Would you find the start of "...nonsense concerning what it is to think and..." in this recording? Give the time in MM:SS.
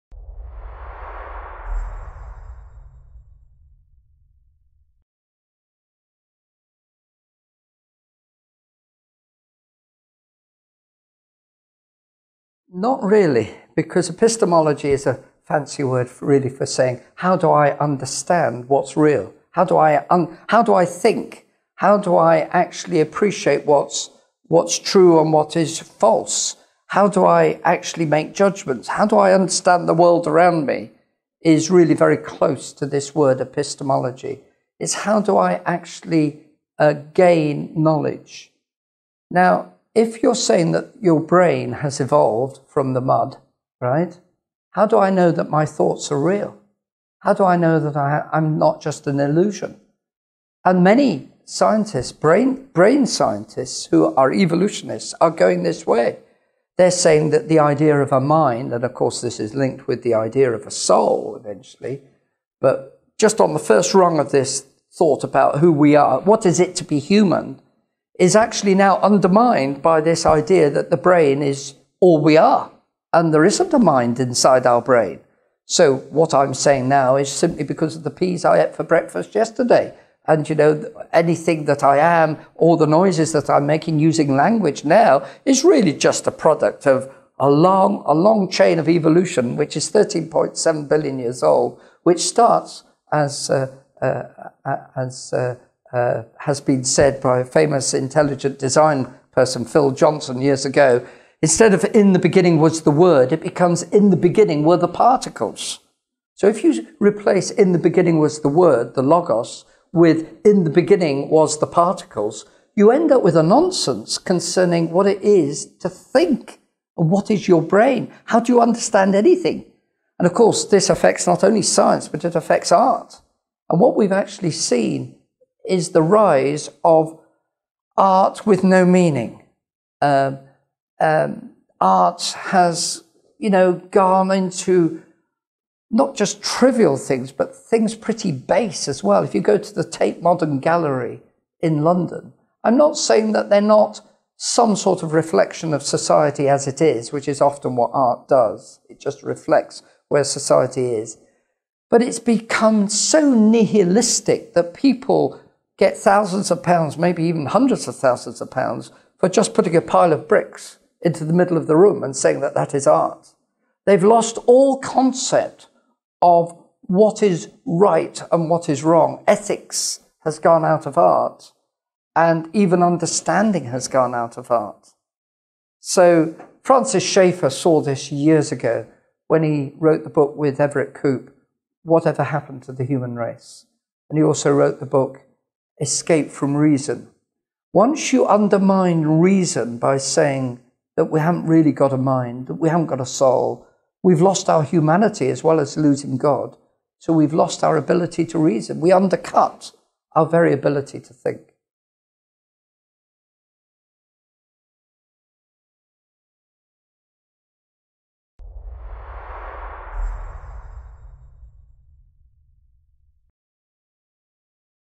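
01:53.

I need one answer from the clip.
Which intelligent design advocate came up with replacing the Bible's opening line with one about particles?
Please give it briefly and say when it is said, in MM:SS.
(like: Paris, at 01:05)
Phil Johnson, at 01:39.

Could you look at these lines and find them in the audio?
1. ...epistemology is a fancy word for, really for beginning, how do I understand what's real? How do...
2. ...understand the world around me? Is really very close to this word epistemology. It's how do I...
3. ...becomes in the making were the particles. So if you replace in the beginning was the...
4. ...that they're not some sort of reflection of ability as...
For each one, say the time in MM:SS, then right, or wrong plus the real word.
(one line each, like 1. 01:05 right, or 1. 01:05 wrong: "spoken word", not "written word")
1. 00:14 wrong: "saying", not "beginning"
2. 00:29 right
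3. 01:43 wrong: "beginning", not "making"
4. 02:23 wrong: "society", not "ability".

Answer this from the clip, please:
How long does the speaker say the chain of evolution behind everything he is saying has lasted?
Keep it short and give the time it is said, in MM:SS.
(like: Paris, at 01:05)
13.7 billion years, at 01:29.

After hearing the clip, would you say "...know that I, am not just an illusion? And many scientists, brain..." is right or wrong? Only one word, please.
right.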